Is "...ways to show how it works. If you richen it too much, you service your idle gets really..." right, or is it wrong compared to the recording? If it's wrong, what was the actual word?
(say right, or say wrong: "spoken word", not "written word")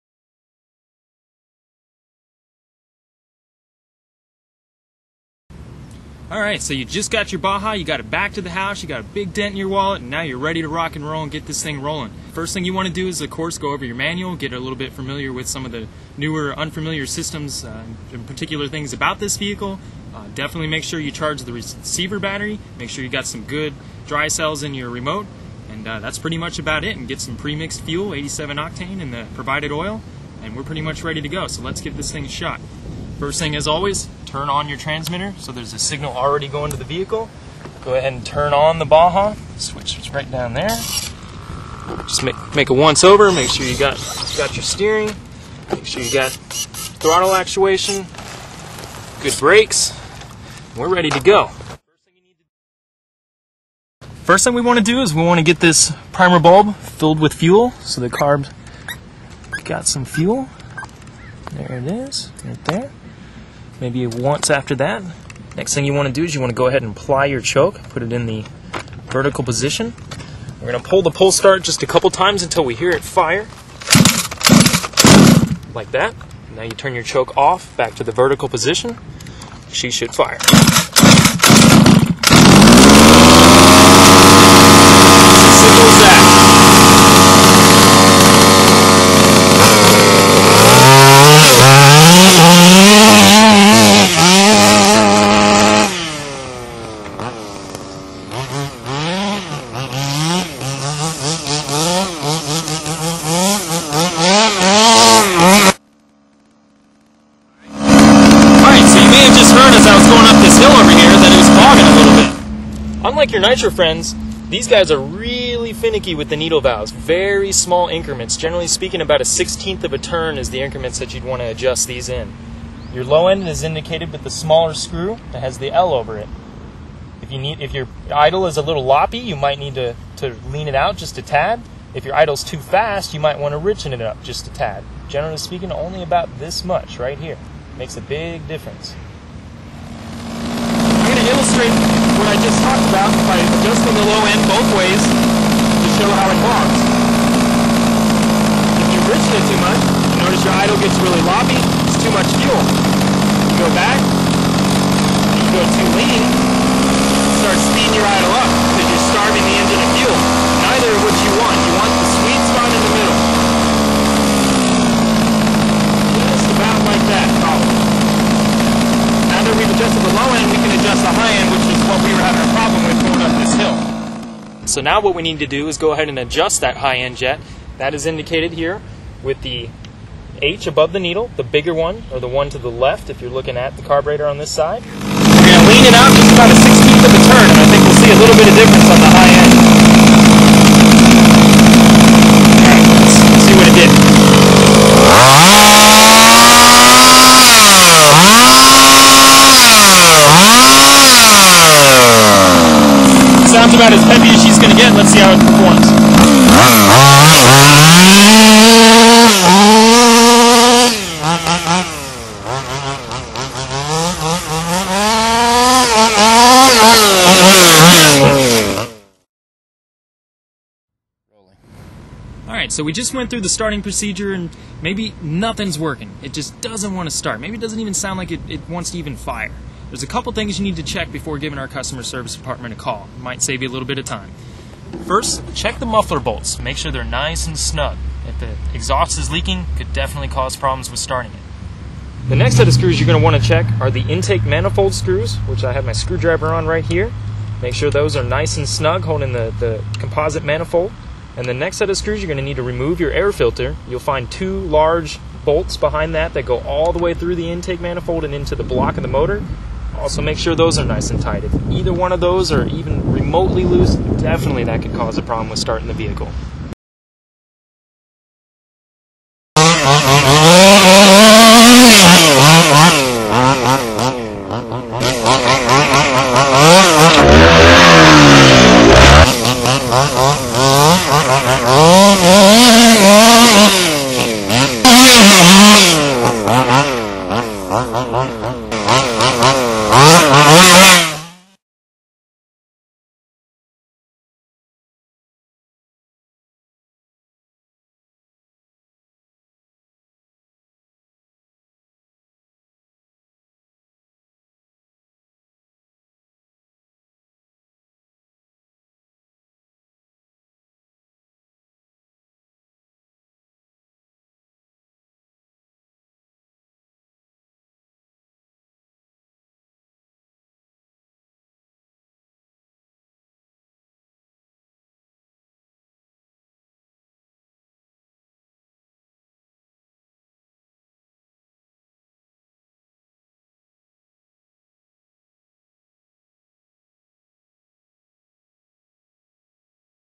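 wrong: "notice", not "service".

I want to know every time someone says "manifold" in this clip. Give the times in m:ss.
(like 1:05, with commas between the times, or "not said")
4:04, 4:10, 4:17.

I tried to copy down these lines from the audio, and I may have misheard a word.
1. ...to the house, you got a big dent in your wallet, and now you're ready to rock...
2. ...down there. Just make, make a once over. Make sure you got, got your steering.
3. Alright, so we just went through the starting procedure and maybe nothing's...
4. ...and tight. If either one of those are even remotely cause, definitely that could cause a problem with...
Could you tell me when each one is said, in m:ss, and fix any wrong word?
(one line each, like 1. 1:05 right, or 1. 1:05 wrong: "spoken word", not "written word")
1. 0:08 right
2. 0:40 right
3. 3:42 right
4. 4:21 wrong: "loose", not "cause".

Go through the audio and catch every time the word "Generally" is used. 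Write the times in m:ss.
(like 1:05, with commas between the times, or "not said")
1:58, 2:15.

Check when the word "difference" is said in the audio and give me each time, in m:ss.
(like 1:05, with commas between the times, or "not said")
2:18, 3:08.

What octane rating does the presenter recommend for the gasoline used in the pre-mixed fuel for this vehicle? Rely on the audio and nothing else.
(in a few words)
87.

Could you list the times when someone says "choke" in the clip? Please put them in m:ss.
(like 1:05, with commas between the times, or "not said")
1:07, 1:17.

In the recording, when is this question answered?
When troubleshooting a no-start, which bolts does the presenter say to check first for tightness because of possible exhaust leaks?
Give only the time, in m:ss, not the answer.
3:55.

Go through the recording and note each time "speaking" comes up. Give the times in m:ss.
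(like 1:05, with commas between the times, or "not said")
1:58, 2:15.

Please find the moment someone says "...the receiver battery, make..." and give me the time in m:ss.
0:21.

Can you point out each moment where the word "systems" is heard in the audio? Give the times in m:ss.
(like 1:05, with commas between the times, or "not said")
0:17.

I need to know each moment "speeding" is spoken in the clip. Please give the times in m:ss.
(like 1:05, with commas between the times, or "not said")
2:37.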